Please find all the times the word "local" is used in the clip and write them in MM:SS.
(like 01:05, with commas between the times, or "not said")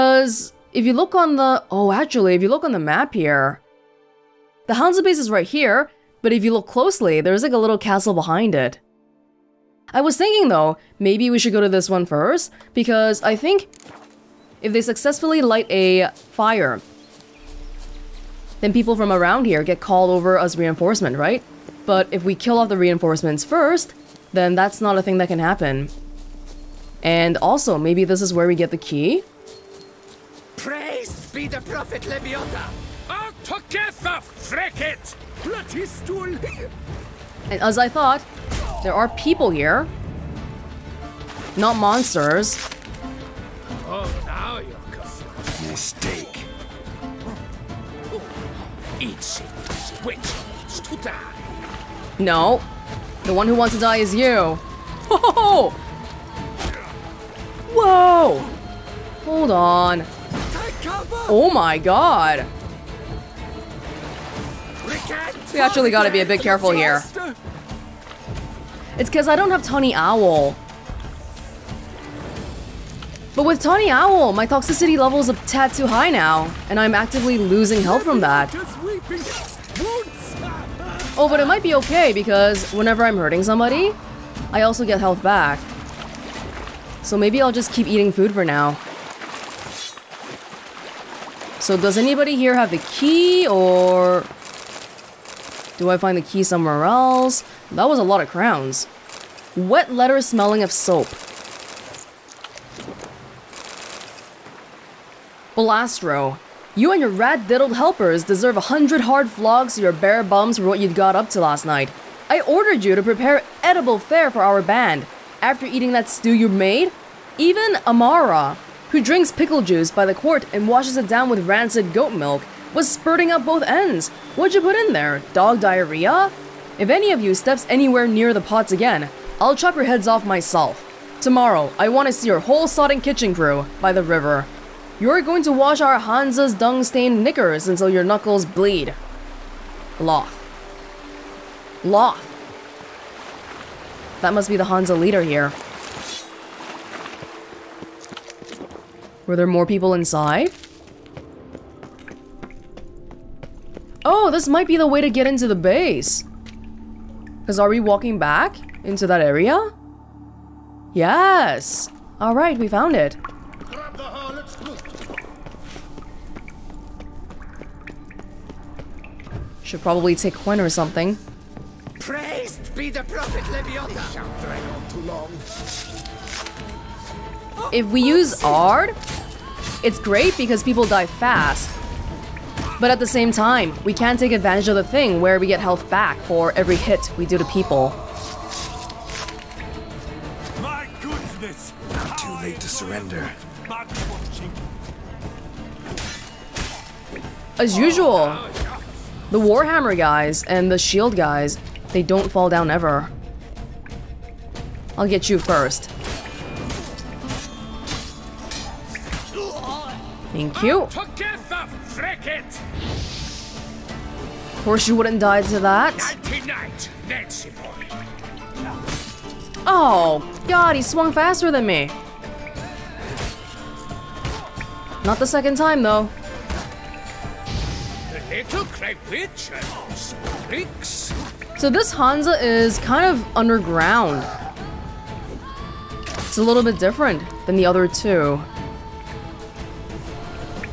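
not said.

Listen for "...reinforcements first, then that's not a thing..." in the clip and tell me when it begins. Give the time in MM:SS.
00:22.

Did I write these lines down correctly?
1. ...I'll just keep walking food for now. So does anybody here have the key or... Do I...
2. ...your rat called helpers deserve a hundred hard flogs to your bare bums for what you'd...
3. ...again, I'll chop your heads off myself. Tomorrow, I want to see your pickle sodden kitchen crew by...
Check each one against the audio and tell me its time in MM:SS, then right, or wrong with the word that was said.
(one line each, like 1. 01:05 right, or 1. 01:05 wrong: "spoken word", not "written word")
1. 01:27 wrong: "eating", not "walking"
2. 01:46 wrong: "diddled", not "called"
3. 02:08 wrong: "whole", not "pickle".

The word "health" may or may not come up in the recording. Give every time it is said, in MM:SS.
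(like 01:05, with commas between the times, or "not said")
01:17, 01:24, 03:05.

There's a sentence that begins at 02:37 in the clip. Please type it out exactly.
Because are we walking back into that area?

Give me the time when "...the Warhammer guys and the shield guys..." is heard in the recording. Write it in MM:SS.
03:19.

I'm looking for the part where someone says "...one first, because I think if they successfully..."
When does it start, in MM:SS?
00:11.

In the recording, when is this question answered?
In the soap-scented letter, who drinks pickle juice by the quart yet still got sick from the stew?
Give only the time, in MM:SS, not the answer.
01:57.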